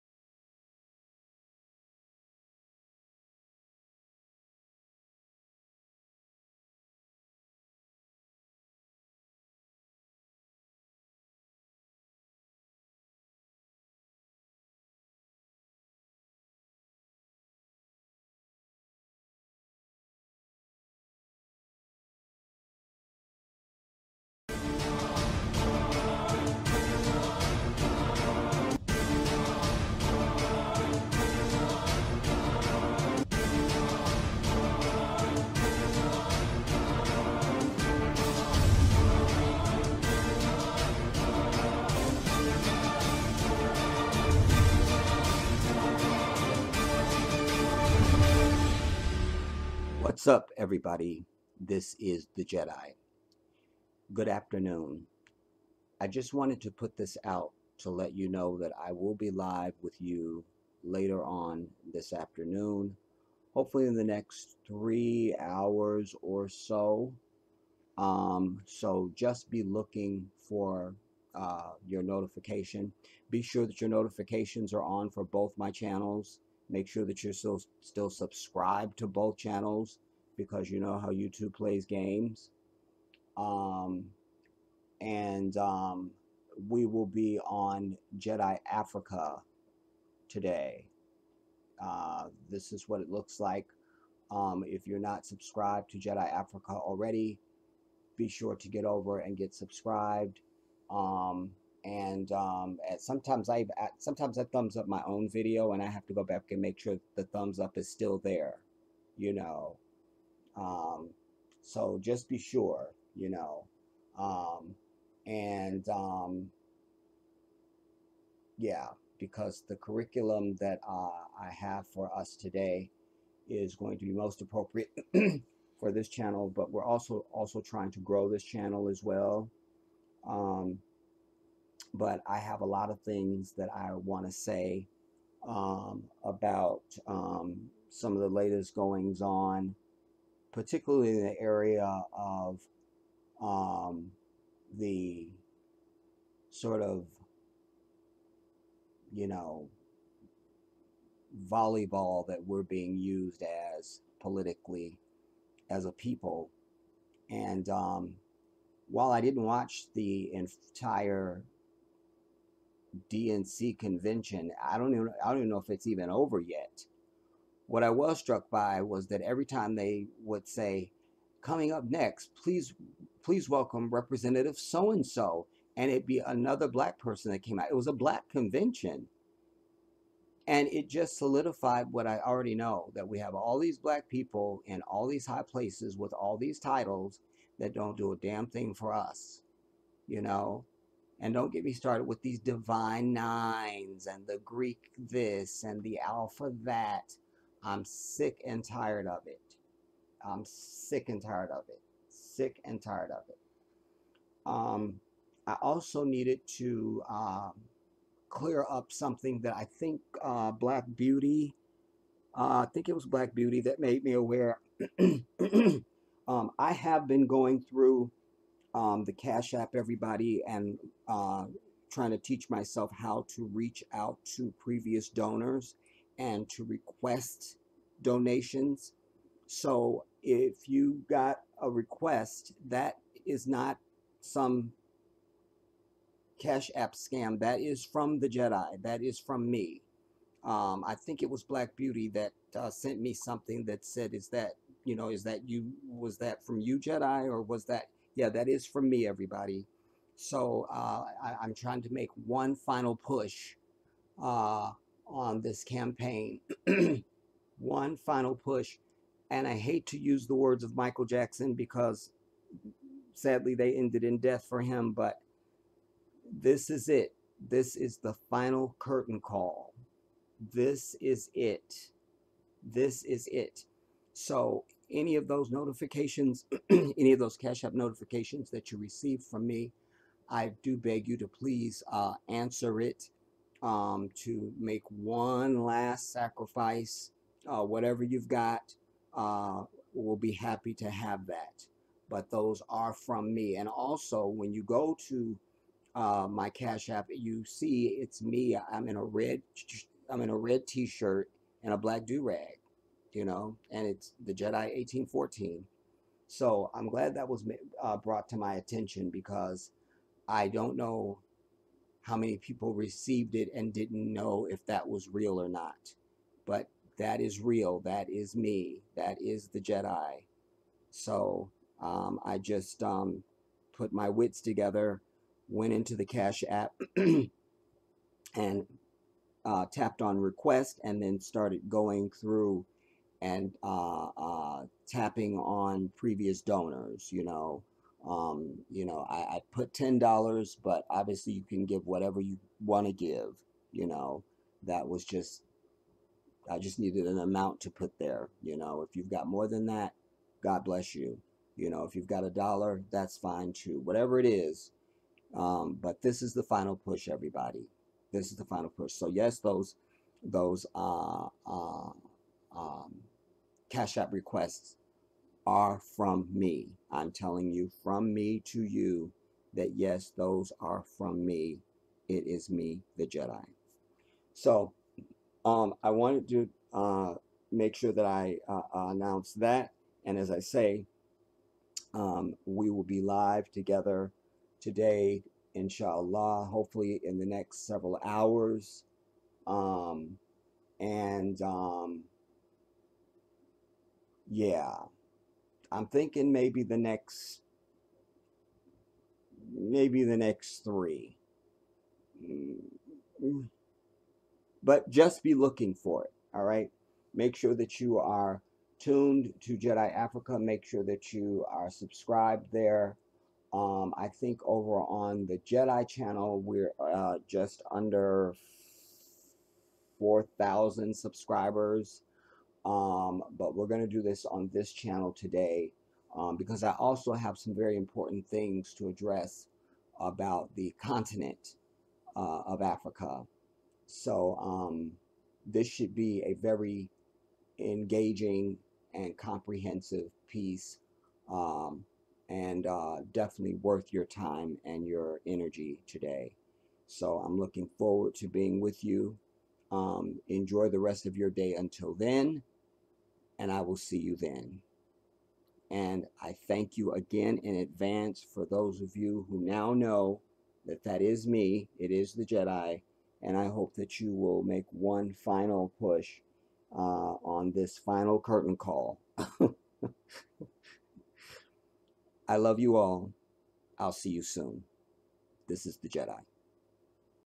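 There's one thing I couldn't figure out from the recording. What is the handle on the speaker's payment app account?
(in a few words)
the Jedi 1814.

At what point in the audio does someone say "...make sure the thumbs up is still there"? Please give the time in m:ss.
1:46.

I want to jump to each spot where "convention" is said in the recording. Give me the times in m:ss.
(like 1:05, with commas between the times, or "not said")
2:43, 2:58.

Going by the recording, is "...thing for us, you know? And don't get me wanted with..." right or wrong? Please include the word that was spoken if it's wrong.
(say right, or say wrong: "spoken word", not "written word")
wrong: "started", not "wanted".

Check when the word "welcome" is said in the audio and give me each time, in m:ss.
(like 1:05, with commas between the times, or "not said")
2:53.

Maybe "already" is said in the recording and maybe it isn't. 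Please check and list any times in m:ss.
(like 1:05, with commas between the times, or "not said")
1:36, 3:02.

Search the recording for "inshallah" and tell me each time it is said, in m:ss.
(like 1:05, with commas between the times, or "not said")
6:25.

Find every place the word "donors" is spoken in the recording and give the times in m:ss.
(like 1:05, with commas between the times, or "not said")
3:45, 5:36.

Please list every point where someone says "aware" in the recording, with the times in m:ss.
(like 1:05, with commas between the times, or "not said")
3:34.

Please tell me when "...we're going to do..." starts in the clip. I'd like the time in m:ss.
7:03.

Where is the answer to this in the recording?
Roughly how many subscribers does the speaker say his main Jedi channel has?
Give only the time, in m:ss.
6:59.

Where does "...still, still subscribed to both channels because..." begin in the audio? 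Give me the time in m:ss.
1:17.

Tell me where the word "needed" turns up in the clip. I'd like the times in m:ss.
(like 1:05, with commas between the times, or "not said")
3:26, 5:46.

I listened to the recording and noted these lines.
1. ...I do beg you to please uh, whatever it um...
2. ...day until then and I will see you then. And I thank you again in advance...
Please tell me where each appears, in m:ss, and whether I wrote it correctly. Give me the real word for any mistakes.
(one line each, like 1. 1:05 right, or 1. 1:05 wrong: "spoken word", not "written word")
1. 4:40 wrong: "answer", not "whatever"
2. 7:31 right.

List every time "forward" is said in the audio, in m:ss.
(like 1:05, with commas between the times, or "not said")
7:27.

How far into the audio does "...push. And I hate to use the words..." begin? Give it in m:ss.
4:18.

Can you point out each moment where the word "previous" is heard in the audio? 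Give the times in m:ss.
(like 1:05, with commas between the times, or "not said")
3:44, 5:35.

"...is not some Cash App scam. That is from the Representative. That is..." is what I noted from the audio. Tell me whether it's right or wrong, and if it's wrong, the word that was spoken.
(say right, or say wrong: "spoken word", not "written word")
wrong: "Jedi", not "Representative".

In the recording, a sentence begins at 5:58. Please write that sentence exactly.
So yes, those those uh, uh, um, cash app requests are from me.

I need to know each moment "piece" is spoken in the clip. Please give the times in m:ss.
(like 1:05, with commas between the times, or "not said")
7:20.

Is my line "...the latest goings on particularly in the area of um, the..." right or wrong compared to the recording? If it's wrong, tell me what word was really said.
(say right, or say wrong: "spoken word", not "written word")
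right.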